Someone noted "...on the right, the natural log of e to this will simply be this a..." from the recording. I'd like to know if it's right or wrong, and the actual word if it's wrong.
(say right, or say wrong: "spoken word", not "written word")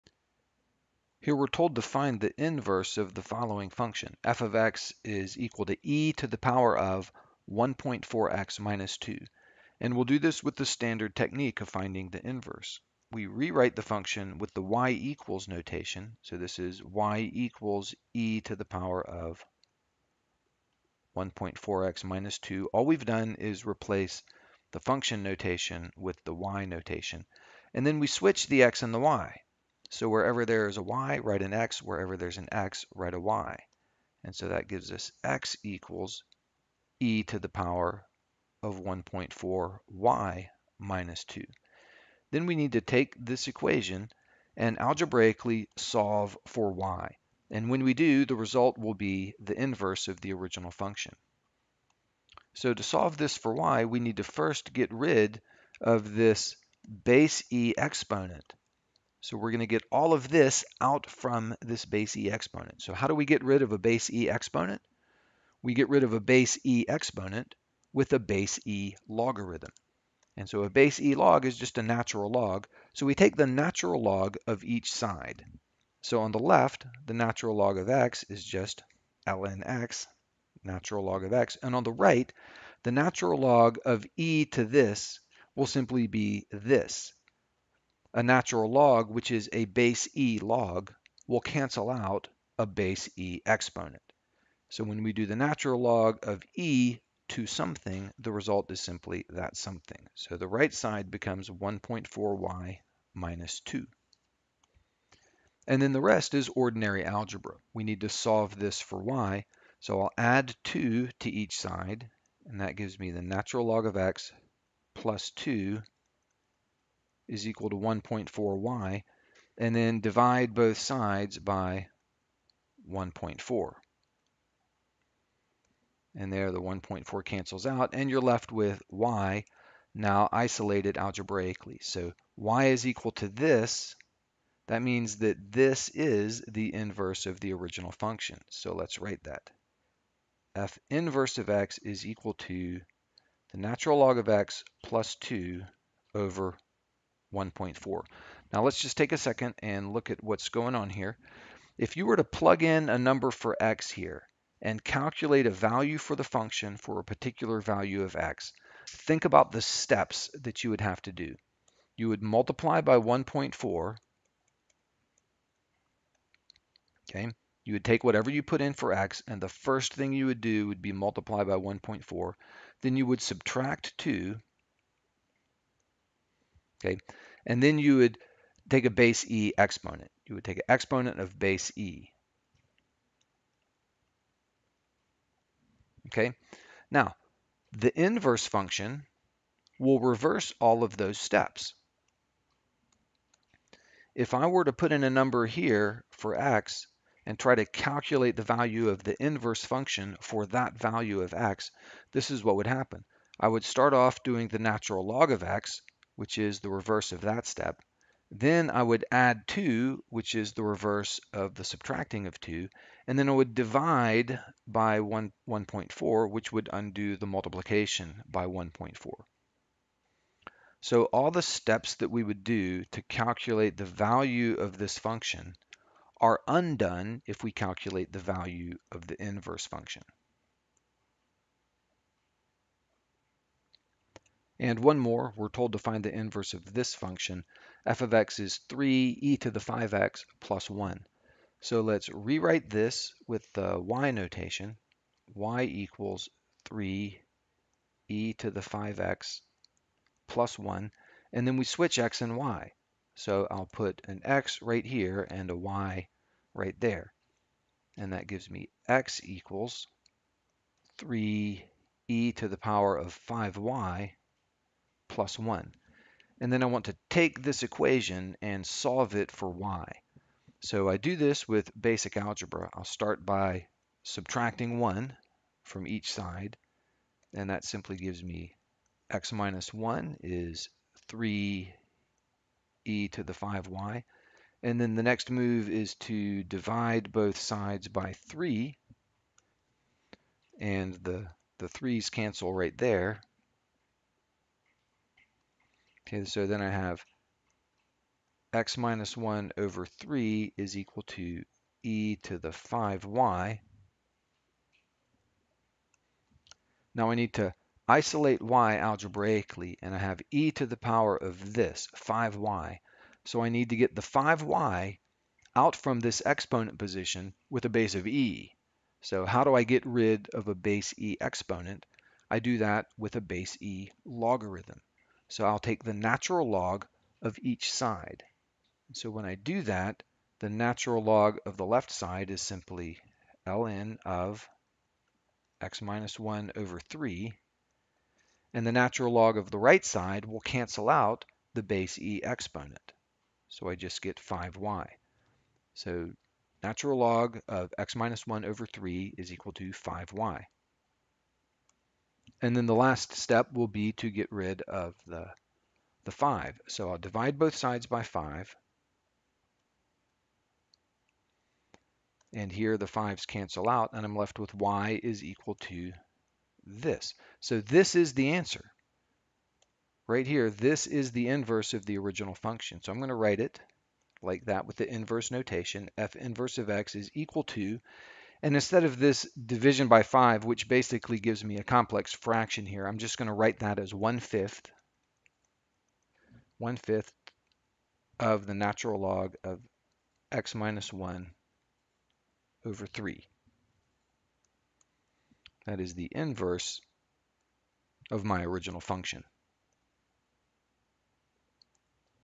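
right.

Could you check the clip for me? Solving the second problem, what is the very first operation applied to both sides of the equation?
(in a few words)
subtracting 1.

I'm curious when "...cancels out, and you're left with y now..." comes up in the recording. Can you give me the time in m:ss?
2:07.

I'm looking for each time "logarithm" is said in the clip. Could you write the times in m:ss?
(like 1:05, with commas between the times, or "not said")
1:09, 5:24.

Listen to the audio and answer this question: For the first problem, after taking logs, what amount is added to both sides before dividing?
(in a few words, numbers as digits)
2.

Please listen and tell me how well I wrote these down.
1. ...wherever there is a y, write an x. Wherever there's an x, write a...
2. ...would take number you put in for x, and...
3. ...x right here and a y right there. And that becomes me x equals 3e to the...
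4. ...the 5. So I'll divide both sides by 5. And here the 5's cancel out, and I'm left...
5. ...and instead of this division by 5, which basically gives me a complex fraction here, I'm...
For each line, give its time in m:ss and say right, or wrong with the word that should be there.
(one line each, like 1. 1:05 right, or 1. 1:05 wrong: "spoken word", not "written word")
1. 0:30 right
2. 2:47 wrong: "whatever", not "number"
3. 4:14 wrong: "gives", not "becomes"
4. 5:56 right
5. 6:18 right.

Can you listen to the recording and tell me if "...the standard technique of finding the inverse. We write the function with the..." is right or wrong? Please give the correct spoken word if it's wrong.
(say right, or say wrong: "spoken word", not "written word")
wrong: "rewrite", not "write".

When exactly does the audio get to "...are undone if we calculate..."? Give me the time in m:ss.
3:46.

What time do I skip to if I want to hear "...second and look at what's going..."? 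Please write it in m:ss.
2:29.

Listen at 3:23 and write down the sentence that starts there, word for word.
I would start off doing the natural log of x, which is the reverse of that step.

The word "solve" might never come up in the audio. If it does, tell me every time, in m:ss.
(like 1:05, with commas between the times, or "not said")
0:45, 0:52, 1:48, 4:28.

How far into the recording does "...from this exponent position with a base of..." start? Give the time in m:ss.
5:15.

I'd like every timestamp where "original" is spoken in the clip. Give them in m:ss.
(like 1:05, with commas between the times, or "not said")
0:50, 2:17, 6:11, 6:38.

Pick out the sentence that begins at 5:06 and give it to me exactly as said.
Now I need to isolate y algebraically, and I have e to the power of this, 5y.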